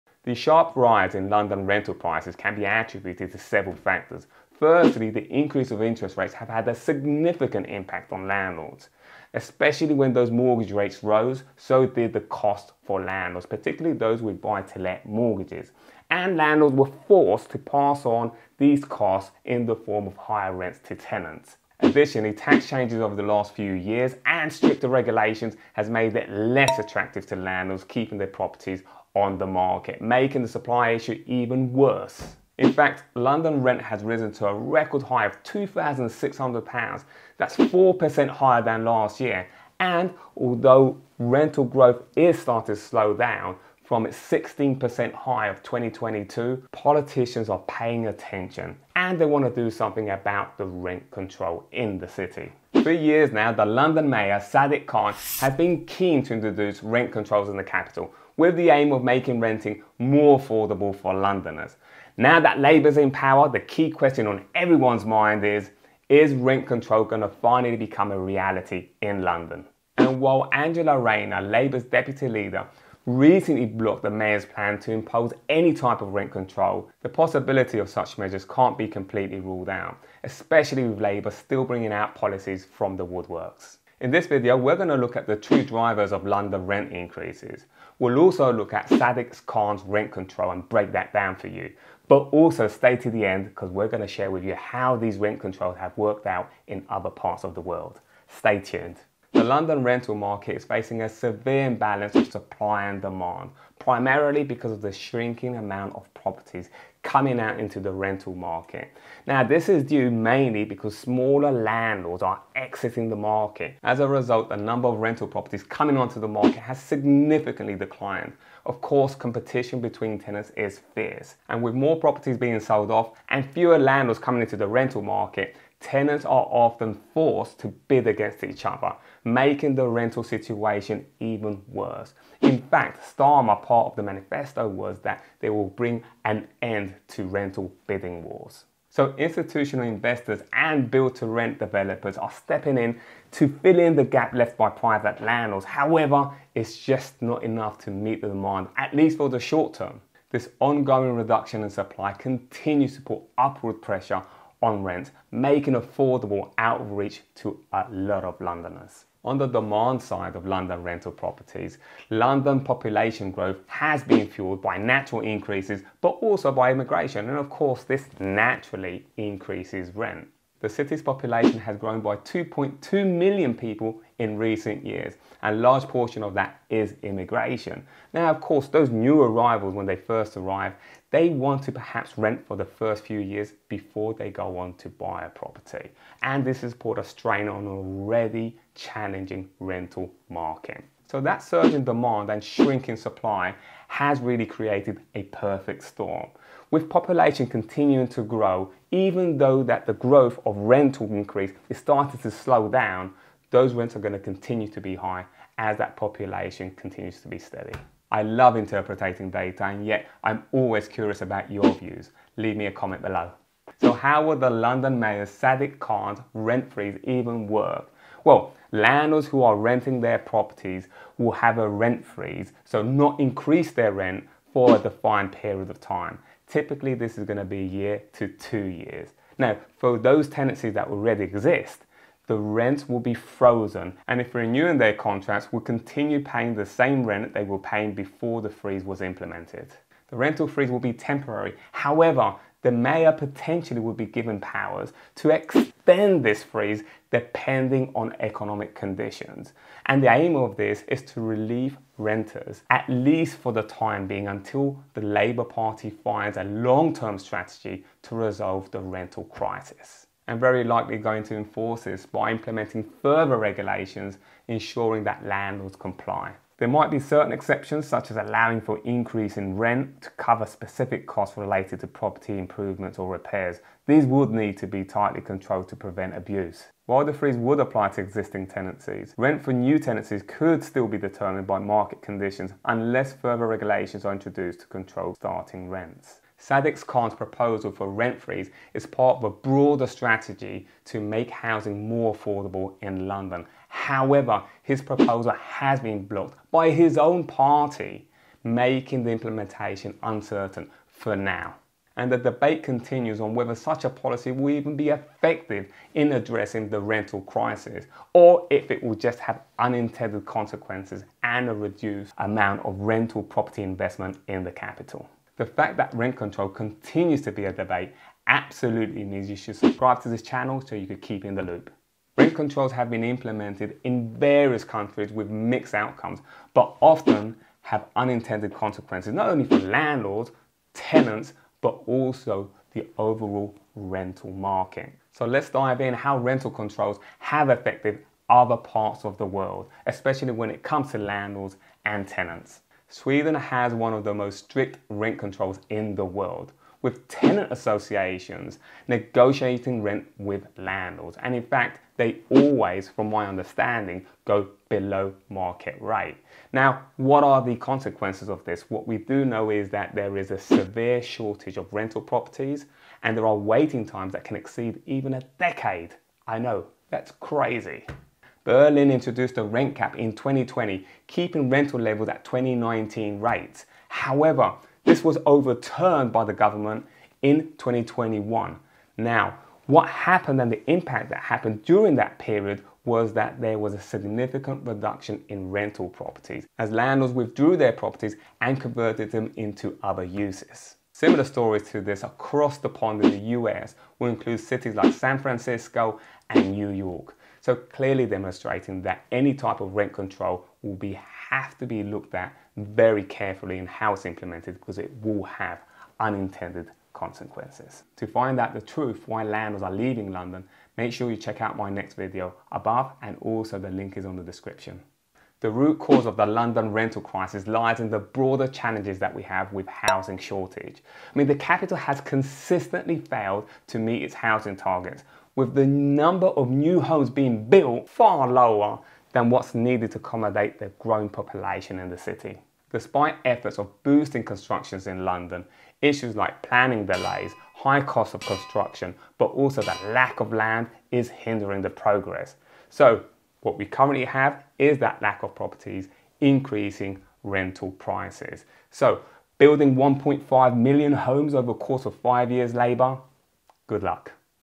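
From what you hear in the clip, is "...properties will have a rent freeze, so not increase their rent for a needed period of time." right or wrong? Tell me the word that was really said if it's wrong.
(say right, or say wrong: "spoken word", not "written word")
wrong: "defined", not "needed".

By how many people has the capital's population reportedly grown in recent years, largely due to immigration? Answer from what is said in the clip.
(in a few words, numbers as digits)
2.2 million.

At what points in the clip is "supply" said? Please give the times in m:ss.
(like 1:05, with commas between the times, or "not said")
0:30, 1:42, 2:31, 3:12.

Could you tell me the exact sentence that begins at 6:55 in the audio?
The root cause of the London rental crisis lies in the broader challenges that we have with housing shortage.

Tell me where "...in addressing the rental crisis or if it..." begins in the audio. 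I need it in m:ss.
5:05.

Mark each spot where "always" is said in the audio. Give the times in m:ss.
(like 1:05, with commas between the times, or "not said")
3:30, 5:52.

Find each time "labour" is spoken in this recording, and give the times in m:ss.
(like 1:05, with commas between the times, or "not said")
1:02, 1:11, 1:21, 4:15, 7:32.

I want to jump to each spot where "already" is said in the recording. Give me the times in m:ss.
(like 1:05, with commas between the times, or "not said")
3:07, 3:50.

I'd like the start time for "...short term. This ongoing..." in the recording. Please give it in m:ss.
2:29.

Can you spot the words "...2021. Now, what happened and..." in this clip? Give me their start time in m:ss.
6:17.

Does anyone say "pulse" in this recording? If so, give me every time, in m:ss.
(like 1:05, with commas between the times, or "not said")
not said.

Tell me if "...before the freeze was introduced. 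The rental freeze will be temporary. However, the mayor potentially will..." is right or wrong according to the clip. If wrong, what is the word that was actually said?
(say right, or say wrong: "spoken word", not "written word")
wrong: "implemented", not "introduced".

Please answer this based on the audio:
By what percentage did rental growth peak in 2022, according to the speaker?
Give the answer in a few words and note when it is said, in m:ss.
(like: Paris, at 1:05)
16%, at 0:44.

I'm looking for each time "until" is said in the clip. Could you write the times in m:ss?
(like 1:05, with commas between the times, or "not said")
4:14.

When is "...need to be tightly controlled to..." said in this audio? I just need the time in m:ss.
4:34.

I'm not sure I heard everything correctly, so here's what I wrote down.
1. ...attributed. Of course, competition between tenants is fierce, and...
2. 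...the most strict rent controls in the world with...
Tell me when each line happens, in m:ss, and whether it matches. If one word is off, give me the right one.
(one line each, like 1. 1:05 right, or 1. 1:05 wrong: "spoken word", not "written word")
1. 1:57 wrong: "declined", not "attributed"
2. 5:44 right.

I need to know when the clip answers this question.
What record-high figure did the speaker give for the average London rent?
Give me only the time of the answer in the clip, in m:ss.
0:35.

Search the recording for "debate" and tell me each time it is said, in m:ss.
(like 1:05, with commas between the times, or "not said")
5:02, 5:17.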